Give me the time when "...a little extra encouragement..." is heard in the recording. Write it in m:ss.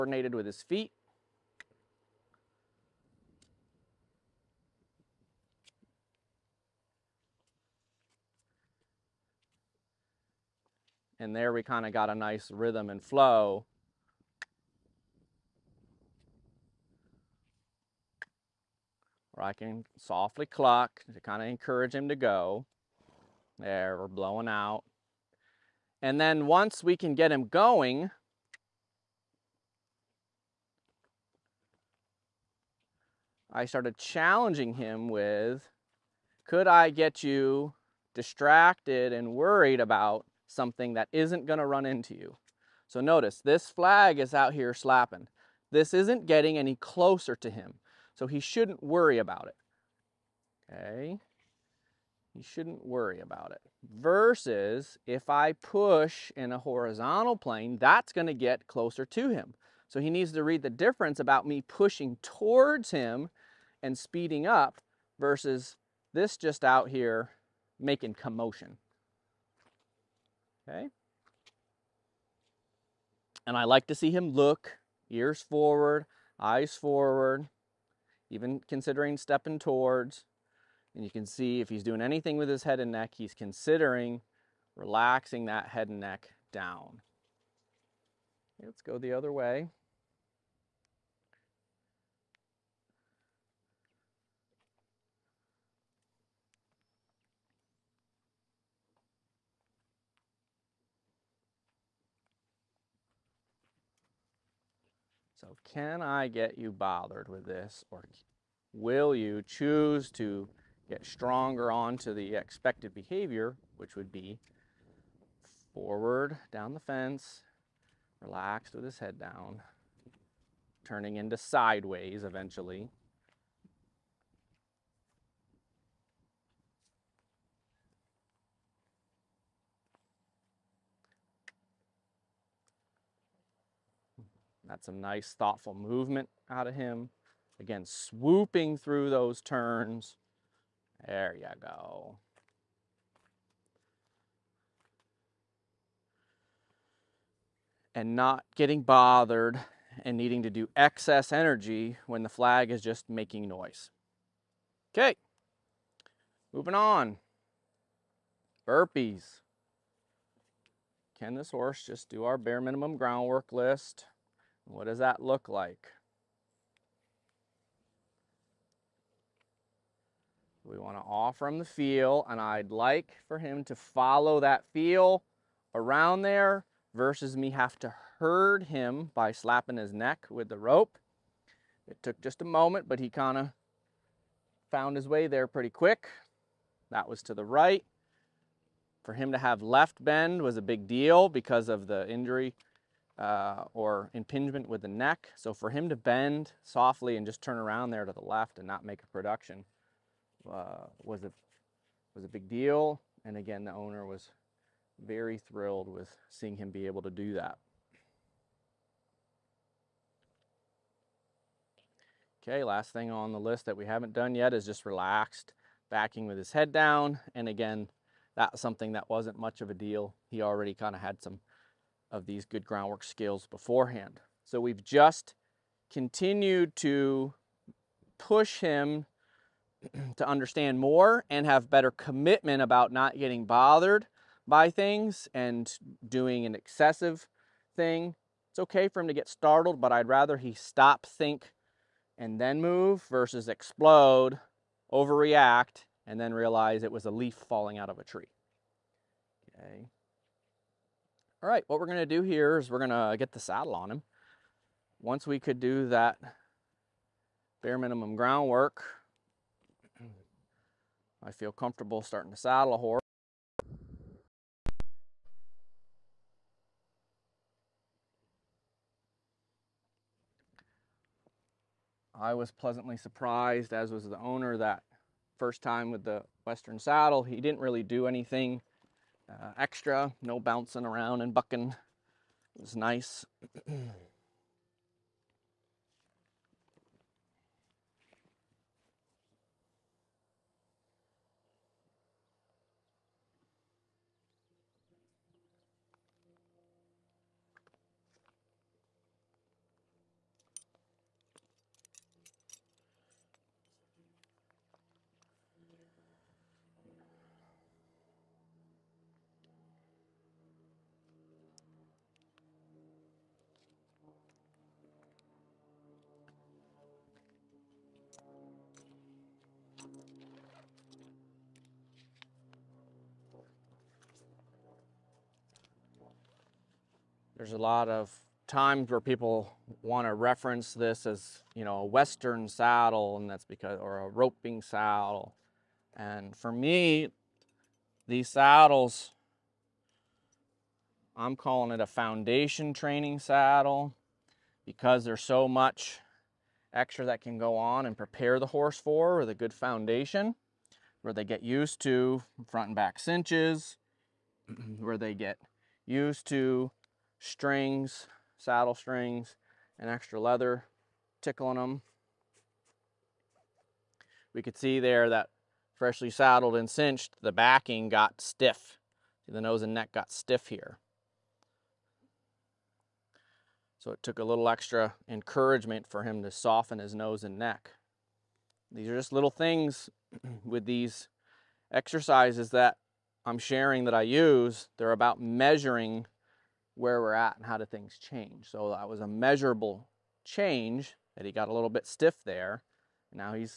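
6:14.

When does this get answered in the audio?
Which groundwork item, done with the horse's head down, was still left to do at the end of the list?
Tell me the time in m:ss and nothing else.
3:34.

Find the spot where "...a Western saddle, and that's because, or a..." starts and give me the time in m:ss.
5:31.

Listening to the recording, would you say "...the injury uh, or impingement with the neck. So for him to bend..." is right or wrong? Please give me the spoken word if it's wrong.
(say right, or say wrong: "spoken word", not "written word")
right.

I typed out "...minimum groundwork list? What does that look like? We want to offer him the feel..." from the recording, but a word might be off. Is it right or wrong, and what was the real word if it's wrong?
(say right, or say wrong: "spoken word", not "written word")
right.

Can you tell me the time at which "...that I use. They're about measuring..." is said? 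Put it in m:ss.
6:23.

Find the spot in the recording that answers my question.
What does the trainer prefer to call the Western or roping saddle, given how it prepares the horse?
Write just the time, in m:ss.
5:41.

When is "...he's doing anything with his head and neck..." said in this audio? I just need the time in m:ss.
1:21.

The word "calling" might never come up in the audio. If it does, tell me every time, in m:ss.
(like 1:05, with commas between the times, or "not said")
5:41.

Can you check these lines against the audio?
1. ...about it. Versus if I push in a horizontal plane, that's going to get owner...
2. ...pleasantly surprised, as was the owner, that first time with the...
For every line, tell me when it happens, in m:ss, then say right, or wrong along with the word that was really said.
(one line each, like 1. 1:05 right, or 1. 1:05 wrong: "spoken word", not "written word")
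1. 0:53 wrong: "closer", not "owner"
2. 4:32 right.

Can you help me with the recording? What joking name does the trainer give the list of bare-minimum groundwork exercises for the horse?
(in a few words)
Burpees.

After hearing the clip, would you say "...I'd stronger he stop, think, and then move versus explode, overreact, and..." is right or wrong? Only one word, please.
wrong.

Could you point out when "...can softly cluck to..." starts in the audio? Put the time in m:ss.
0:19.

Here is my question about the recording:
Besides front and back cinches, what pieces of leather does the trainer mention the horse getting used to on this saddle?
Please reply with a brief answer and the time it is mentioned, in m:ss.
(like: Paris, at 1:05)
saddle strings, at 5:58.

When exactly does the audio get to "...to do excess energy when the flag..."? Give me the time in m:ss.
2:30.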